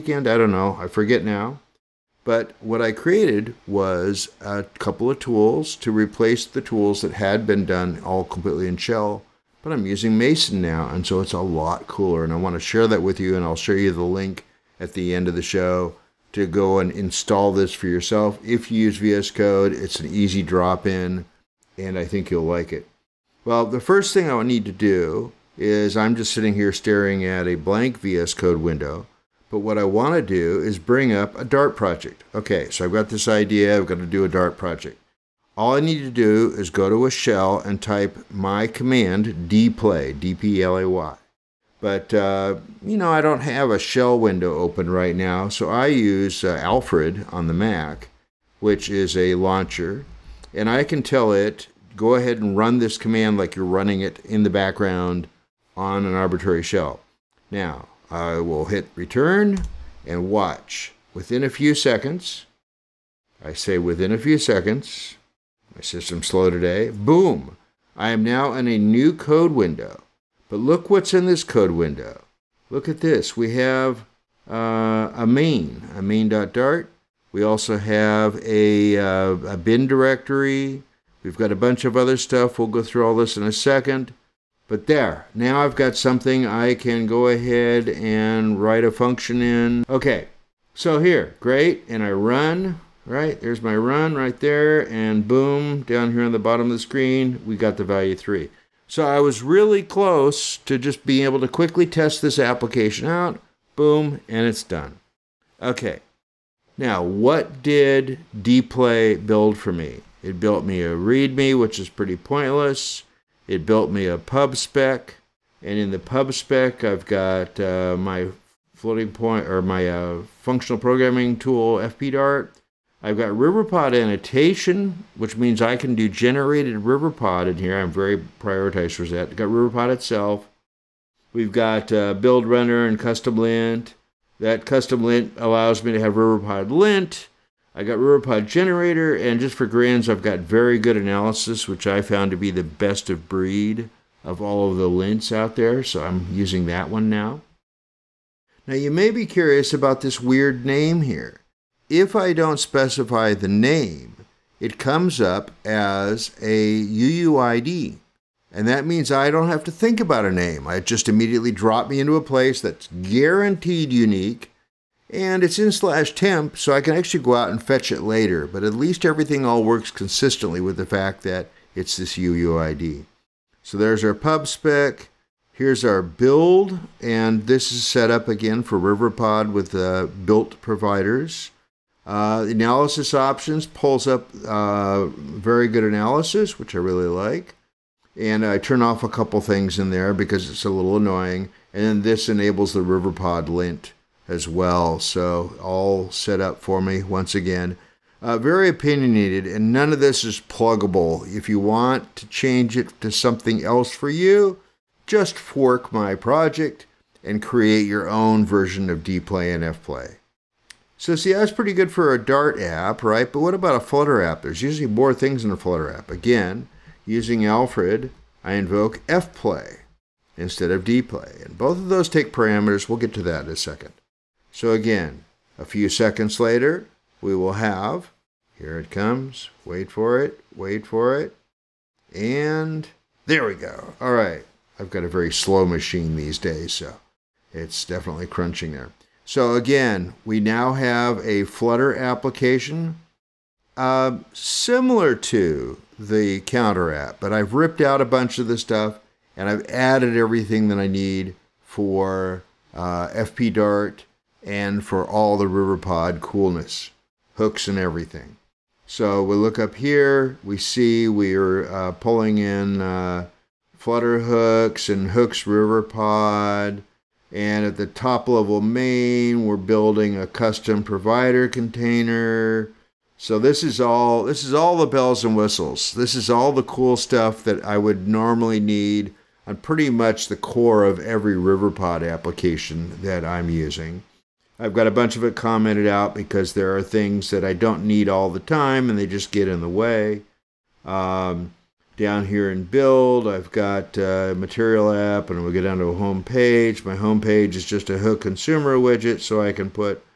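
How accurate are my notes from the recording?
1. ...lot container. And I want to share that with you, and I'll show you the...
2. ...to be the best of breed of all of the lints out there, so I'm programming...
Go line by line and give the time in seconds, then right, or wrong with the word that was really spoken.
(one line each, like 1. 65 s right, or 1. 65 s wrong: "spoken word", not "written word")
1. 11 s wrong: "cooler", not "container"
2. 142 s wrong: "using", not "programming".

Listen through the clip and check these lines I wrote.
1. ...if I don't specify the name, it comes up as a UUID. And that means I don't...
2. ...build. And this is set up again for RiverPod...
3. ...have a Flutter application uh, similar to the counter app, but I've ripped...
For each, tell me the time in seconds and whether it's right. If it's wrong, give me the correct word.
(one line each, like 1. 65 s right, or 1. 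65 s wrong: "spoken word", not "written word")
1. 151 s right
2. 176 s right
3. 240 s right.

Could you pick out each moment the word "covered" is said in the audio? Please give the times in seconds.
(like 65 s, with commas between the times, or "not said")
not said.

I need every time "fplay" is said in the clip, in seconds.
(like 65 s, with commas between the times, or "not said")
209 s, 219 s.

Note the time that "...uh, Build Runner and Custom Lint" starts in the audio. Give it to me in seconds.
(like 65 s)
131 s.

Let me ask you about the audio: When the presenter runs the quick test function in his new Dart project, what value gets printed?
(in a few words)
3.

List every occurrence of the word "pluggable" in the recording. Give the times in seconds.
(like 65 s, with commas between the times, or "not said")
200 s.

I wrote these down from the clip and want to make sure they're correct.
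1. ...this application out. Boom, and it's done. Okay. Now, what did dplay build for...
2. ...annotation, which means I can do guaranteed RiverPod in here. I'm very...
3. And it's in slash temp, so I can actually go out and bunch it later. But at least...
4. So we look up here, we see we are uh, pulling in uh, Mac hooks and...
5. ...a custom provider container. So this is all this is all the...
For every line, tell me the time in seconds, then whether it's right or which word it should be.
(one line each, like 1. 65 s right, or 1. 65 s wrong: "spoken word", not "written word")
1. 102 s right
2. 123 s wrong: "generated", not "guaranteed"
3. 165 s wrong: "fetch", not "bunch"
4. 258 s wrong: "Flutter", not "Mac"
5. 270 s right.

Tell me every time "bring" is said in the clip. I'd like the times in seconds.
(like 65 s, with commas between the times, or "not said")
30 s.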